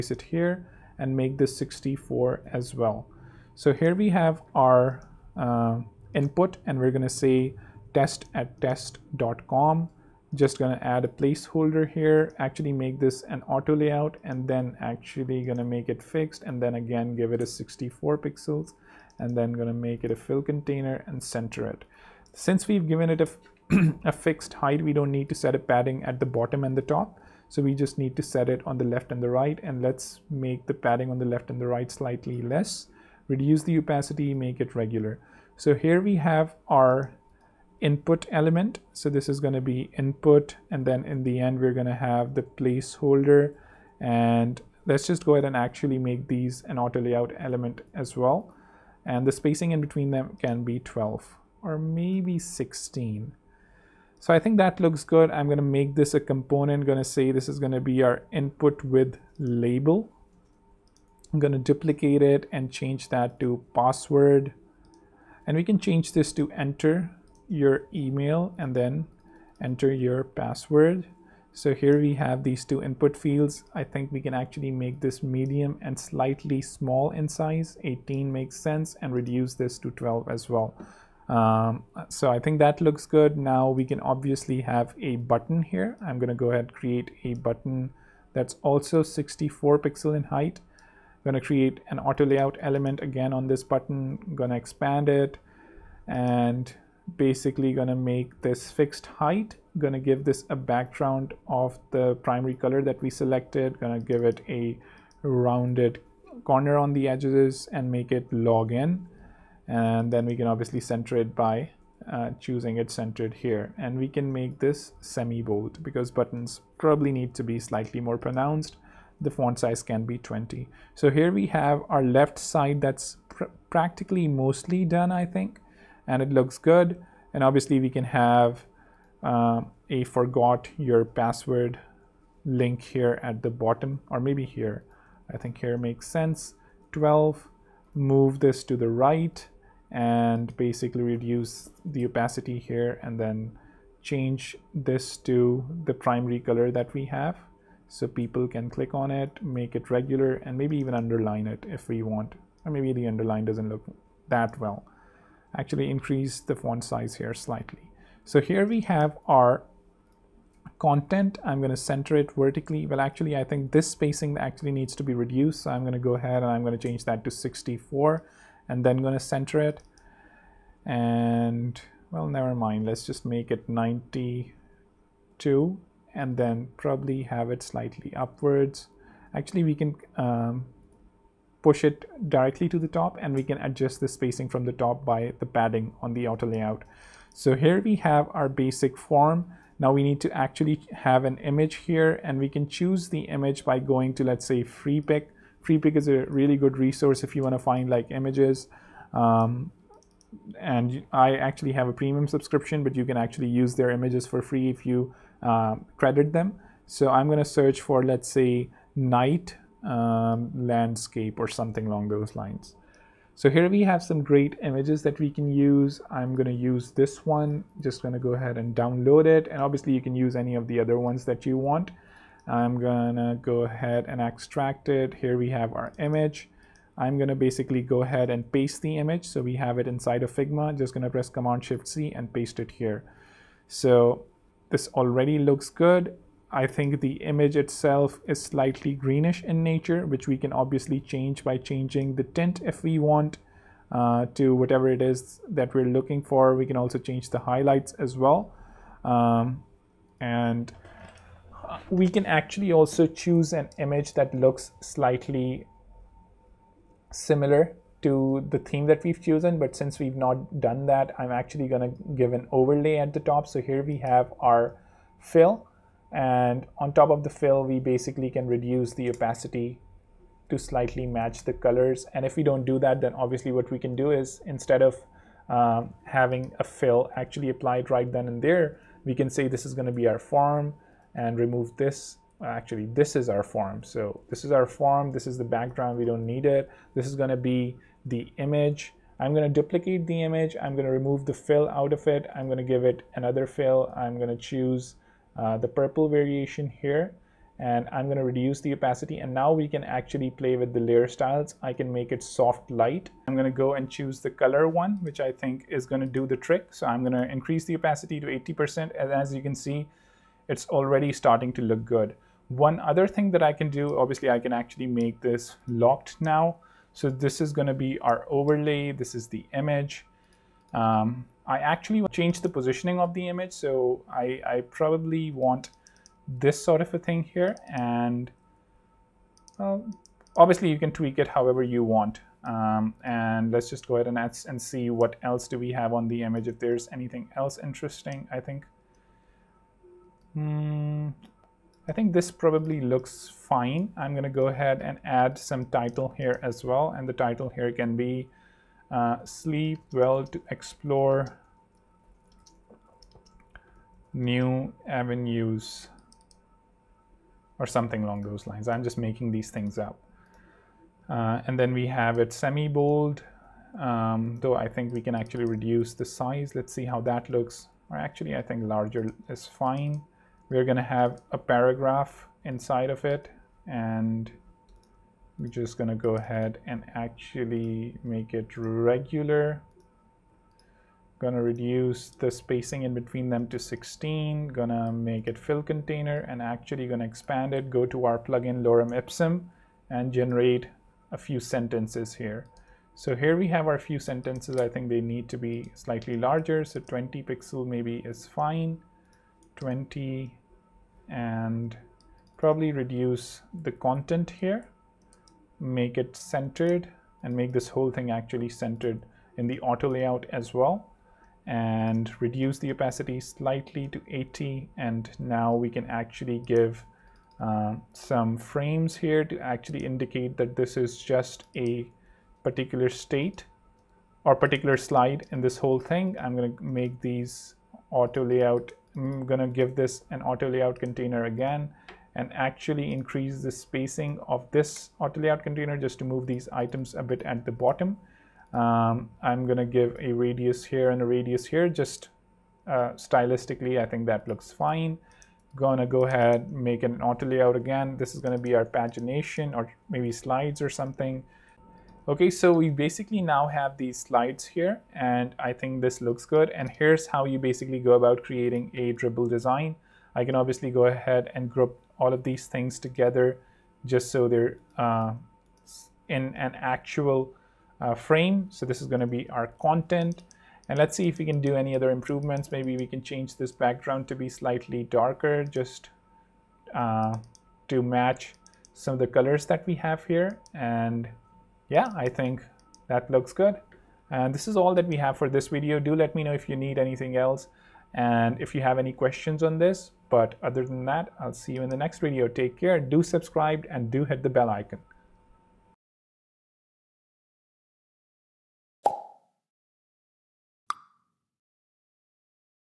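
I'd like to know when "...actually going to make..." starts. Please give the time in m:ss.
0:14.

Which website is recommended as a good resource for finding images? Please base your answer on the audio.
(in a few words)
Freepik.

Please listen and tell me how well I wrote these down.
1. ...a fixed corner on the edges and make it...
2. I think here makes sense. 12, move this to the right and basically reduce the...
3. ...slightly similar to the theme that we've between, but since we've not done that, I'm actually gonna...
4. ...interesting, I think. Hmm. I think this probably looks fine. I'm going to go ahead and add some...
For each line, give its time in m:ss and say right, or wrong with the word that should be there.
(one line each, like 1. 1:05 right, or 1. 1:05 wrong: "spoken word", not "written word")
1. 1:44 wrong: "rounded", not "fixed"
2. 2:15 right
3. 4:14 wrong: "chosen", not "between"
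4. 5:37 right.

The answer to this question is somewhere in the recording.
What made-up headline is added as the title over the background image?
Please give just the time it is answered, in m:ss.
5:49.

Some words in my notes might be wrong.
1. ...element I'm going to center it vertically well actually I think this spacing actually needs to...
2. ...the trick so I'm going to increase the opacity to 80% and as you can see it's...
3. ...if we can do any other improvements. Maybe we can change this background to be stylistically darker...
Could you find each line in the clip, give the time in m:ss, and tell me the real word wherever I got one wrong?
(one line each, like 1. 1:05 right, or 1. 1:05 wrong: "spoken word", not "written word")
1. 2:40 wrong: "content", not "element"
2. 5:06 right
3. 7:51 wrong: "slightly", not "stylistically".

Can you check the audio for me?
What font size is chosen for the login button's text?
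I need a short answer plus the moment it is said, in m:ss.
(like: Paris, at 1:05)
20, at 1:59.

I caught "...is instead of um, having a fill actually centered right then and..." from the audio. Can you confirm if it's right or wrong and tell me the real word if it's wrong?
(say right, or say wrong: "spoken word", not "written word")
wrong: "applied", not "centered".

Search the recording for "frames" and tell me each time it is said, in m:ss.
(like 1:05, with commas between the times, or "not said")
6:58, 7:47.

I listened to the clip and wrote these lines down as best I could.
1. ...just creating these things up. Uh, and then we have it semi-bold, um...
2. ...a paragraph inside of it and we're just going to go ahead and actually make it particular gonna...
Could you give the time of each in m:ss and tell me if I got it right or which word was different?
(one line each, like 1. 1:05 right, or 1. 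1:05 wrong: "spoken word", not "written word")
1. 5:58 wrong: "making", not "creating"
2. 6:11 wrong: "regular", not "particular".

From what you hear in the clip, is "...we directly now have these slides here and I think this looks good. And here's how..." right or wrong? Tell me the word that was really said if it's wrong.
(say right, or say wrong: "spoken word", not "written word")
wrong: "basically", not "directly".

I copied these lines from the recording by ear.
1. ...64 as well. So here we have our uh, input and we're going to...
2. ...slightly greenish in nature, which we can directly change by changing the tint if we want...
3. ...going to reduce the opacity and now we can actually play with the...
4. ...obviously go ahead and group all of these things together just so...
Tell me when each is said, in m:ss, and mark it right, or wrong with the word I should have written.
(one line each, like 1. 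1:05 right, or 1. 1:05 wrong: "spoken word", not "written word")
1. 0:01 right
2. 3:58 wrong: "obviously", not "directly"
3. 4:58 right
4. 7:40 right.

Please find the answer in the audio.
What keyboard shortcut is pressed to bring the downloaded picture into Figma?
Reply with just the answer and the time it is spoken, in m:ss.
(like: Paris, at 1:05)
Command Shift C, at 3:51.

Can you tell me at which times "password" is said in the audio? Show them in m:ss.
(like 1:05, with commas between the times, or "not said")
1:03, 1:10, 2:11.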